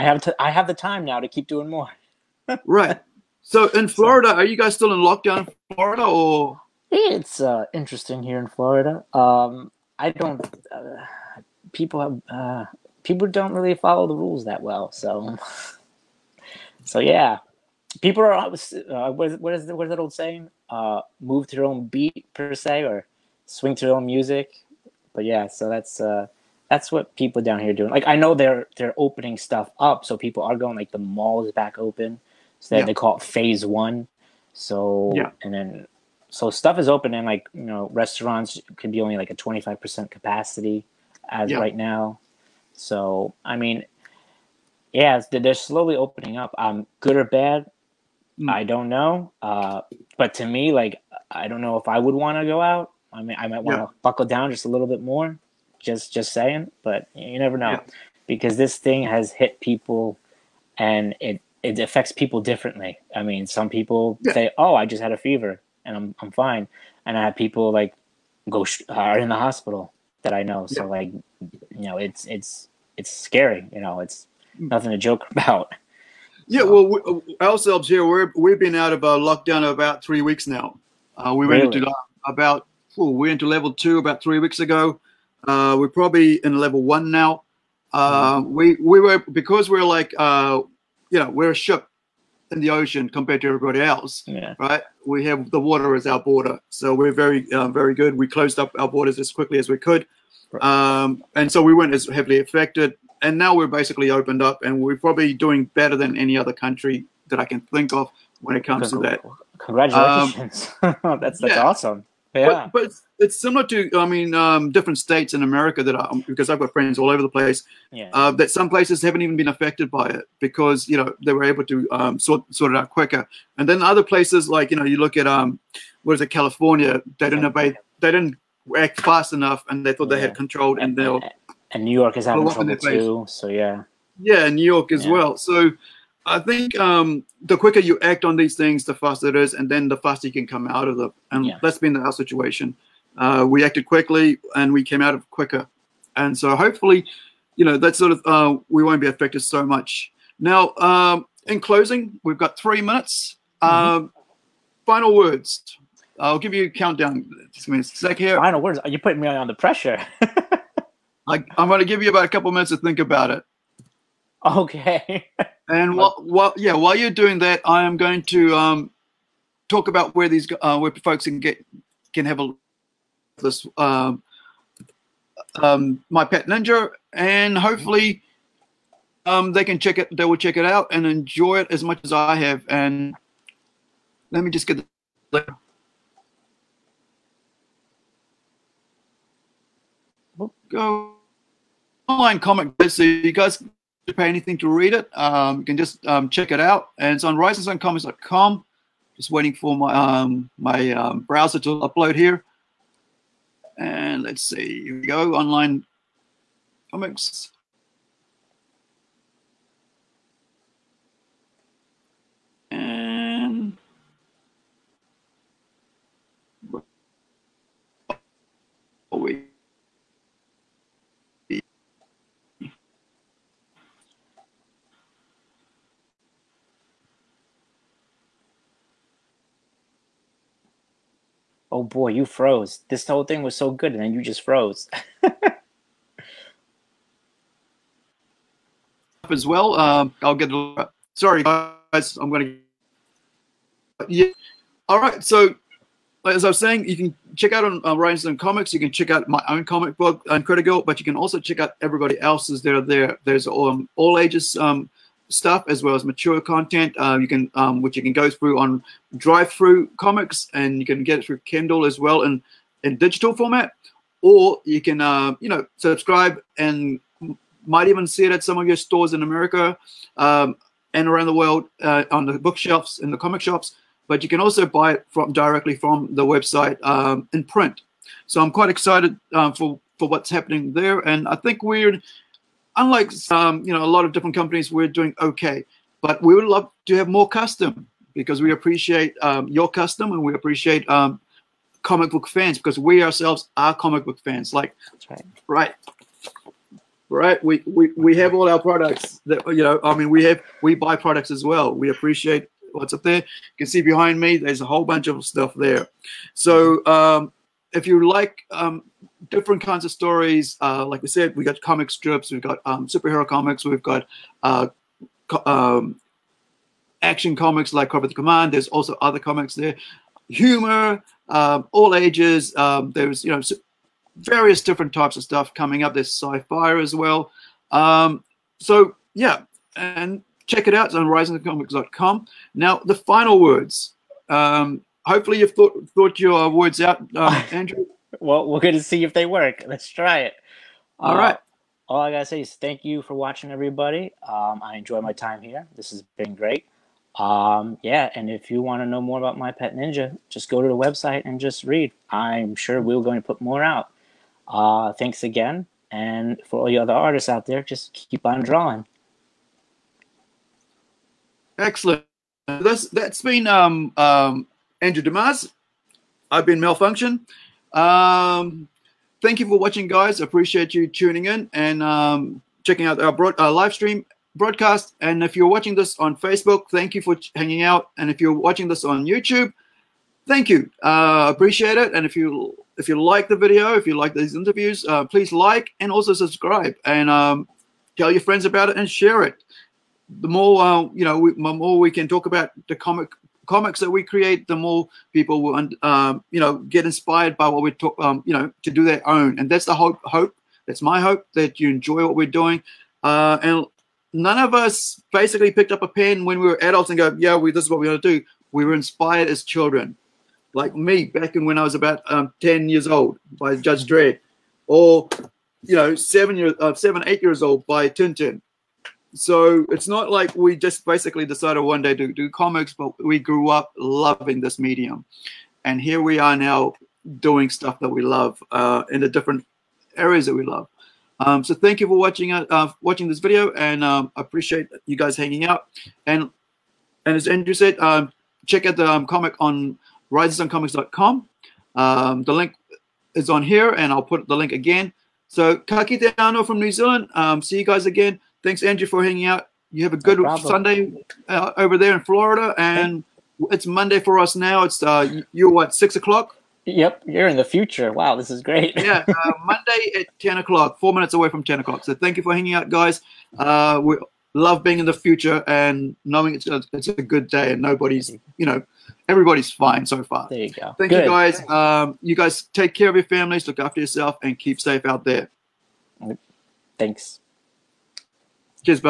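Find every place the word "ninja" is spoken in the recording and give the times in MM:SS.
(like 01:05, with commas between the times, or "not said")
02:56, 05:49.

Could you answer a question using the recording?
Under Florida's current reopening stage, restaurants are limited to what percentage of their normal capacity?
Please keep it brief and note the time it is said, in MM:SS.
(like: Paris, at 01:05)
25%, at 00:39.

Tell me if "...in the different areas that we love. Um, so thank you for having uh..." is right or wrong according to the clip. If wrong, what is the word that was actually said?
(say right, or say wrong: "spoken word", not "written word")
wrong: "watching", not "having".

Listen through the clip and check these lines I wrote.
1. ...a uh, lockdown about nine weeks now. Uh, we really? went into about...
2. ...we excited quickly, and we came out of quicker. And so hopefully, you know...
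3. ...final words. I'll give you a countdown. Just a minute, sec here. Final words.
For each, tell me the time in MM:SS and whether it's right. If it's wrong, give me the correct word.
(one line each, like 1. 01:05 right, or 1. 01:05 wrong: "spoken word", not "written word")
1. 01:19 wrong: "three", not "nine"
2. 02:23 wrong: "acted", not "excited"
3. 02:34 right.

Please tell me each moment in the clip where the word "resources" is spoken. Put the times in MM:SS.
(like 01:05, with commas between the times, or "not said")
not said.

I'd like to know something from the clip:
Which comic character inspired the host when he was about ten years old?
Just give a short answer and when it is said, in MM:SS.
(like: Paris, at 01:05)
Judge Dredd, at 06:53.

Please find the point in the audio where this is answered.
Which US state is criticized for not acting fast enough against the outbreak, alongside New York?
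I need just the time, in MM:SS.
02:06.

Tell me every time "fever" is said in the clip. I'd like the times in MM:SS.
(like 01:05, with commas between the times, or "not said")
01:05.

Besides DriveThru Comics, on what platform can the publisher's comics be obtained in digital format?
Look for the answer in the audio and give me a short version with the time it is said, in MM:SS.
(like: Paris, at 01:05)
Kindle, at 04:21.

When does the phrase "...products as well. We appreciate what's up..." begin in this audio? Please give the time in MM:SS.
05:00.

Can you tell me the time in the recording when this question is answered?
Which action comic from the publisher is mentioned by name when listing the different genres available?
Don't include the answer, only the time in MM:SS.
05:17.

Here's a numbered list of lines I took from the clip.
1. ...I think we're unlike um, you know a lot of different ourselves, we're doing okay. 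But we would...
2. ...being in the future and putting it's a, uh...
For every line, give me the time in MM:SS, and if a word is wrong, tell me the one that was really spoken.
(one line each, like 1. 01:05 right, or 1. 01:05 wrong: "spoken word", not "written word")
1. 04:41 wrong: "companies", not "ourselves"
2. 07:44 wrong: "knowing", not "putting".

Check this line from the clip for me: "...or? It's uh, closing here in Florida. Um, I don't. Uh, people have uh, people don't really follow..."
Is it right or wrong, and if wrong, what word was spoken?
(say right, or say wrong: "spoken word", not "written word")
wrong: "interesting", not "closing".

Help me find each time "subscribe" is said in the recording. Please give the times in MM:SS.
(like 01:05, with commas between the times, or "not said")
04:25, 06:26.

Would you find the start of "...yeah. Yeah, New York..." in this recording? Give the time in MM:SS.
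02:13.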